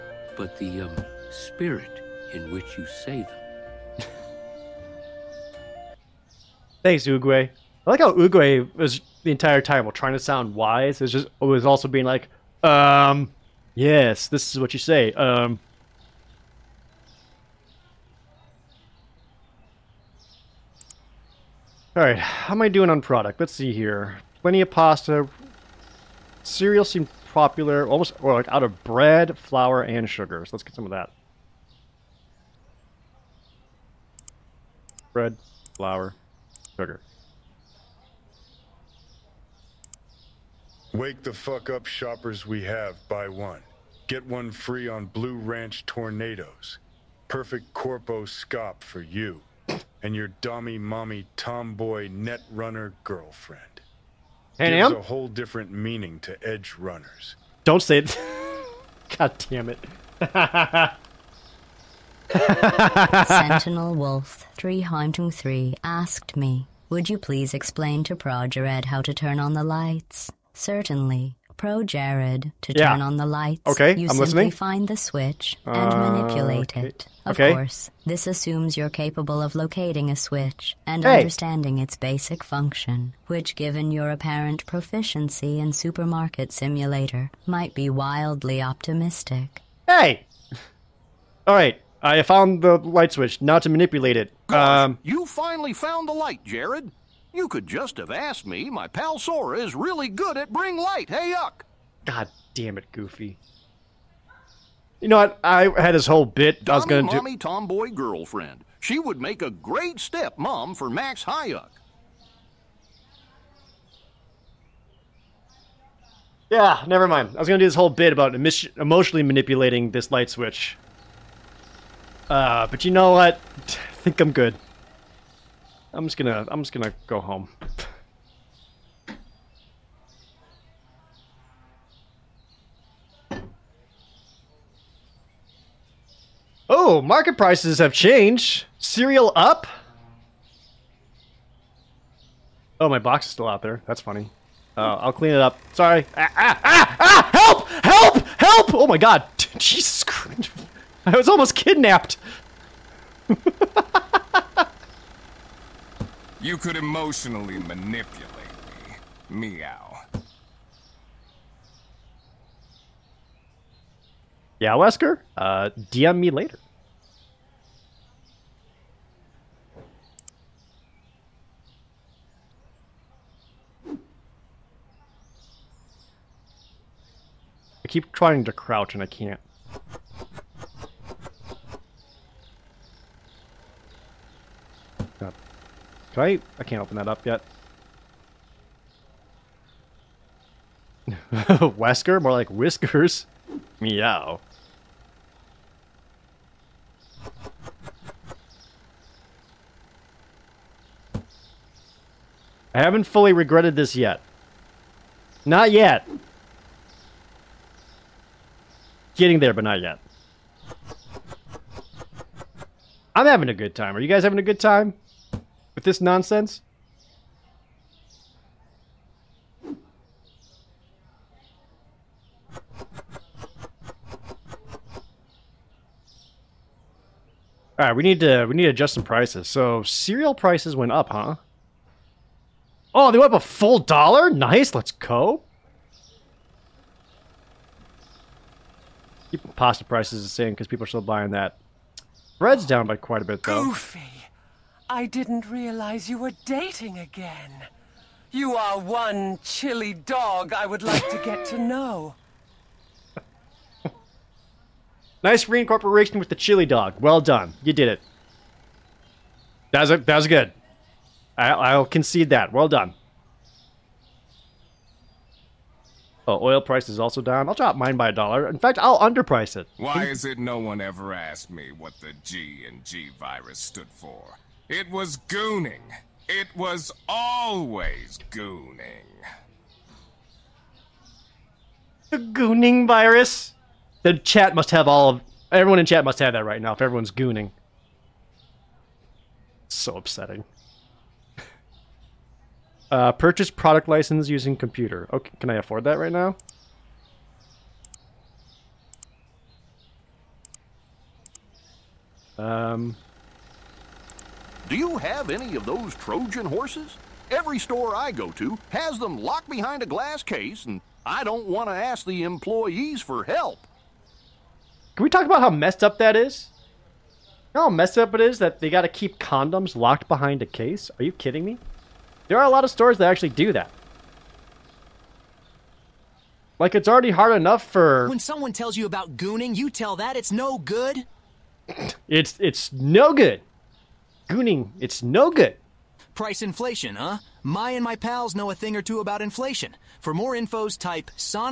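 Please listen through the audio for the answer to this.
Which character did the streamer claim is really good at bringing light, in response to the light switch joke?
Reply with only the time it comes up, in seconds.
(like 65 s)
99 s.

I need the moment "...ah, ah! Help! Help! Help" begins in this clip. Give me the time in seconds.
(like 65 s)
146 s.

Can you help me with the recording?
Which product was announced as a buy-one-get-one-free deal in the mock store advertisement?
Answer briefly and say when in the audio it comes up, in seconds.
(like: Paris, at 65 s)
Blue Ranch Tornadoes, at 45 s.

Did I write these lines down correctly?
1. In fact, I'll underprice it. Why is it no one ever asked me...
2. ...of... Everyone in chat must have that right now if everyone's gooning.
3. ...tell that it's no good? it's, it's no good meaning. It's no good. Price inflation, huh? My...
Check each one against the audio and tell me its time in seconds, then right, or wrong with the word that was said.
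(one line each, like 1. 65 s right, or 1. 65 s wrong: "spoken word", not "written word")
1. 268 s right
2. 285 s right
3. 329 s wrong: "gooning", not "meaning".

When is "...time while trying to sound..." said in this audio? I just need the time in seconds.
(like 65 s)
9 s.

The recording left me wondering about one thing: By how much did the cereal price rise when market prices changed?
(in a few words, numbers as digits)
a full dollar.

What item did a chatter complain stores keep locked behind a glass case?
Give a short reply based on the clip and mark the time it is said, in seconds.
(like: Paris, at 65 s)
condoms, at 319 s.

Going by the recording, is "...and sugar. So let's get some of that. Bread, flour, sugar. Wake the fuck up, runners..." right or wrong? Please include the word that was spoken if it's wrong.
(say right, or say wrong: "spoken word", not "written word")
wrong: "shoppers", not "runners".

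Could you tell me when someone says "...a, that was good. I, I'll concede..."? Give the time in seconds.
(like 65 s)
259 s.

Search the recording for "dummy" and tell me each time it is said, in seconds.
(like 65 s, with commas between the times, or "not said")
50 s, 106 s.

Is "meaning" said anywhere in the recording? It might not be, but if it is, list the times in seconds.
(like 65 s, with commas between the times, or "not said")
55 s.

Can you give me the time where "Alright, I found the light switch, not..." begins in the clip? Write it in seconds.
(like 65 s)
91 s.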